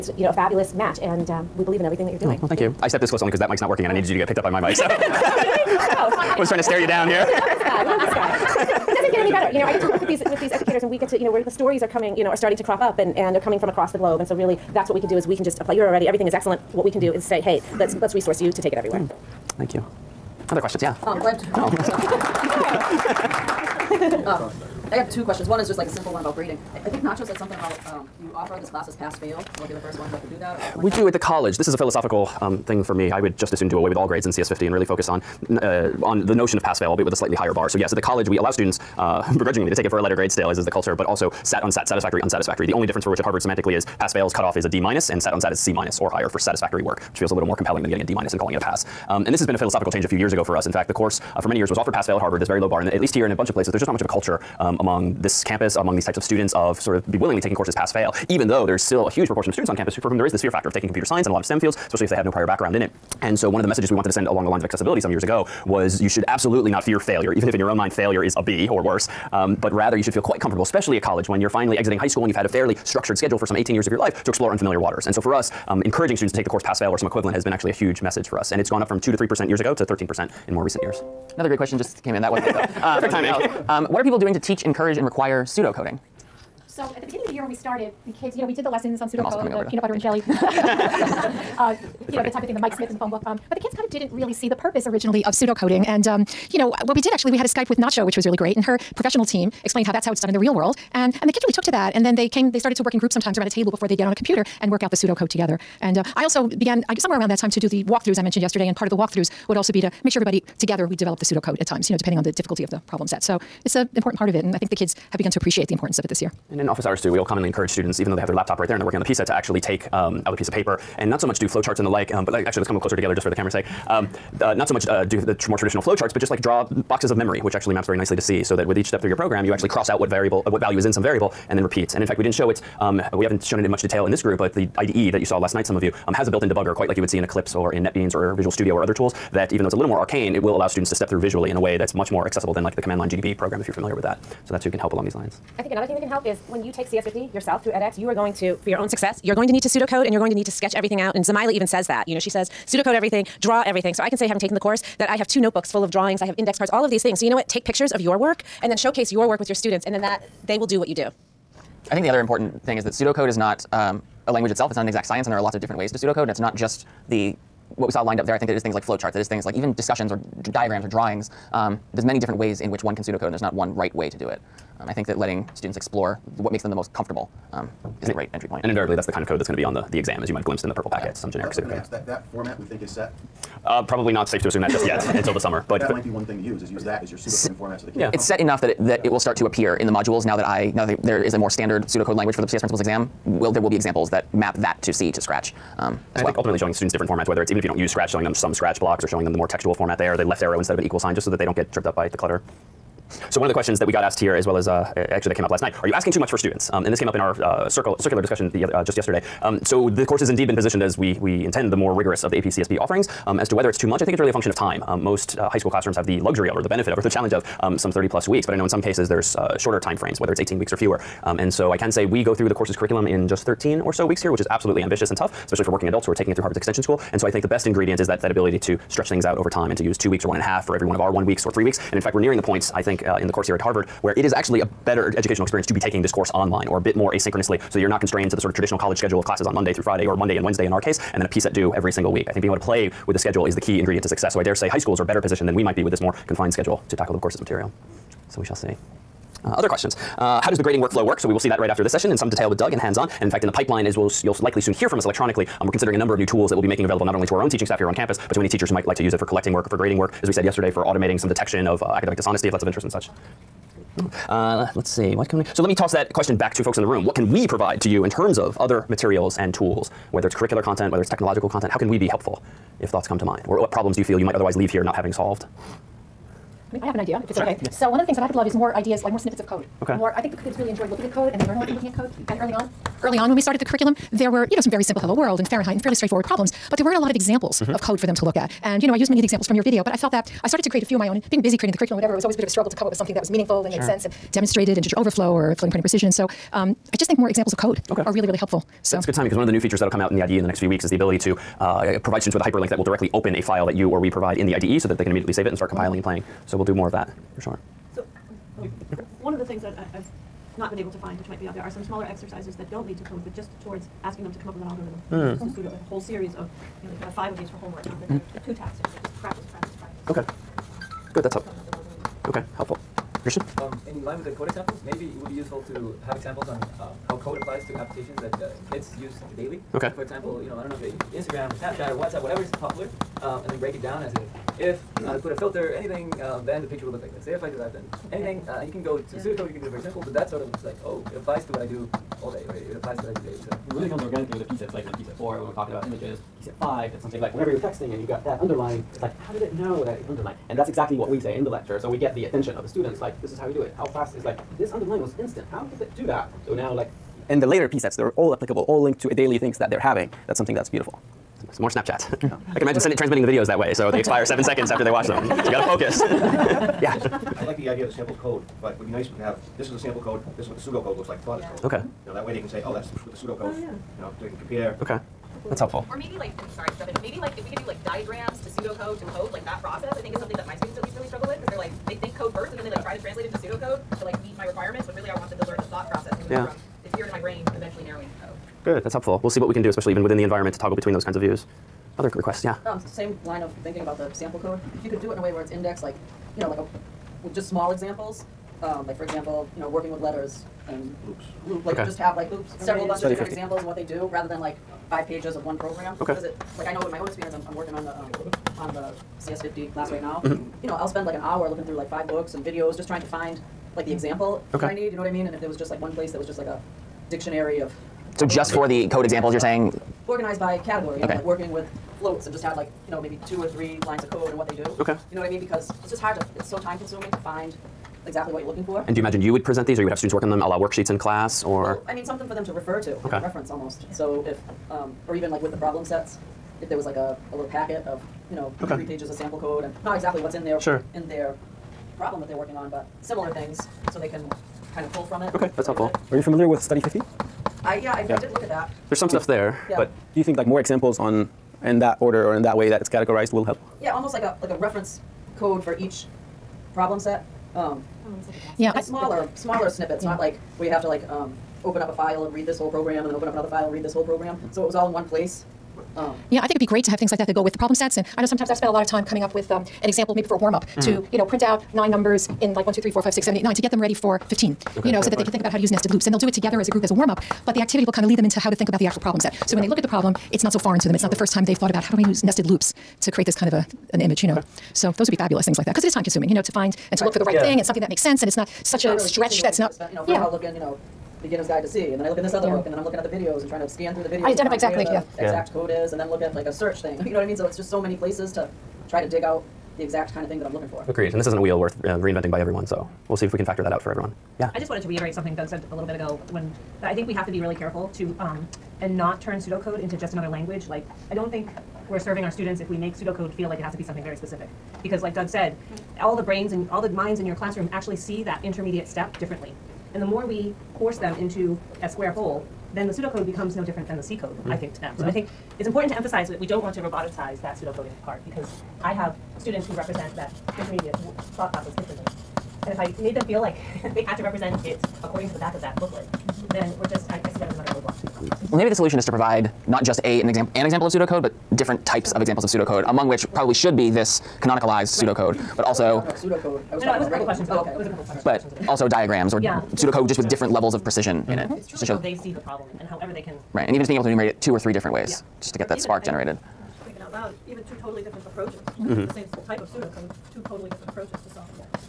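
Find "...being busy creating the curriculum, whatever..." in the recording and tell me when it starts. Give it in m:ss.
4:51.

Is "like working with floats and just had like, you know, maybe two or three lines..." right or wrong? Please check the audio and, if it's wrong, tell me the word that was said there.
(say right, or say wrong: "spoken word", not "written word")
right.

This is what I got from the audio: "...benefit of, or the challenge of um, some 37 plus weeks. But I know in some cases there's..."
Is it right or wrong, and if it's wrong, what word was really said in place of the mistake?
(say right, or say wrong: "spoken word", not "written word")
wrong: "30", not "37".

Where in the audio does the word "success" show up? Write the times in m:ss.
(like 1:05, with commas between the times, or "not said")
2:28, 4:04.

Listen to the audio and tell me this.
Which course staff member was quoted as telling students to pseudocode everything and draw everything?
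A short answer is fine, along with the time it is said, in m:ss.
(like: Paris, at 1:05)
Zamyla, at 2:31.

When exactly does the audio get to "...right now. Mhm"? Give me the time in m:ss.
6:49.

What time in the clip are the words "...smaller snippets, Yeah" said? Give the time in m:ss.
7:39.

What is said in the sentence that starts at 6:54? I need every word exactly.
that I need, you know what I mean?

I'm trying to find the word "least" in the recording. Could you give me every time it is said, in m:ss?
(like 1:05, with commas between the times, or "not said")
0:52, 6:20.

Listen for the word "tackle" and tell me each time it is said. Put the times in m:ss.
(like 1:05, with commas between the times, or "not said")
4:06.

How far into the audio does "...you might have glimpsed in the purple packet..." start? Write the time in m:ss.
3:00.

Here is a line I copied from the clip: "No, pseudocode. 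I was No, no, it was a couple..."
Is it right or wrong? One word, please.
right.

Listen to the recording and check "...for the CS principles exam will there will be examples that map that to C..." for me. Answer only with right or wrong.
right.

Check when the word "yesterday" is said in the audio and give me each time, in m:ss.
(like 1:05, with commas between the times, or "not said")
1:48, 3:28, 4:20.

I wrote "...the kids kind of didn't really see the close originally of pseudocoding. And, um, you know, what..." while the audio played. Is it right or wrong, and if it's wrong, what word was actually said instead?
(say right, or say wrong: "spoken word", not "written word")
wrong: "purpose", not "close".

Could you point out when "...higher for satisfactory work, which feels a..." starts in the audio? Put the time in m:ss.
0:46.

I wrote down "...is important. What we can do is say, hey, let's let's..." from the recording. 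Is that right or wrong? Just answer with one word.
wrong.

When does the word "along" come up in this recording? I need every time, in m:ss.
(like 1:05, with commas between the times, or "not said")
1:04, 2:24.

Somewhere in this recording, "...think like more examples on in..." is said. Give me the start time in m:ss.
7:30.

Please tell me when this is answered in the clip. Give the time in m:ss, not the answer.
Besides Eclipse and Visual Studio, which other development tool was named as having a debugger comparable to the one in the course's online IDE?
2:17.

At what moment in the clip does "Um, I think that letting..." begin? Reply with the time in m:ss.
2:54.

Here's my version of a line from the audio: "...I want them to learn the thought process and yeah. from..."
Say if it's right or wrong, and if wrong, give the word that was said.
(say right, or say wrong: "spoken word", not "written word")
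right.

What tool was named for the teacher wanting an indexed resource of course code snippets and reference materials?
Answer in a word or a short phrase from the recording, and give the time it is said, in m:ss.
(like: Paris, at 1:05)
Study 50, at 7:26.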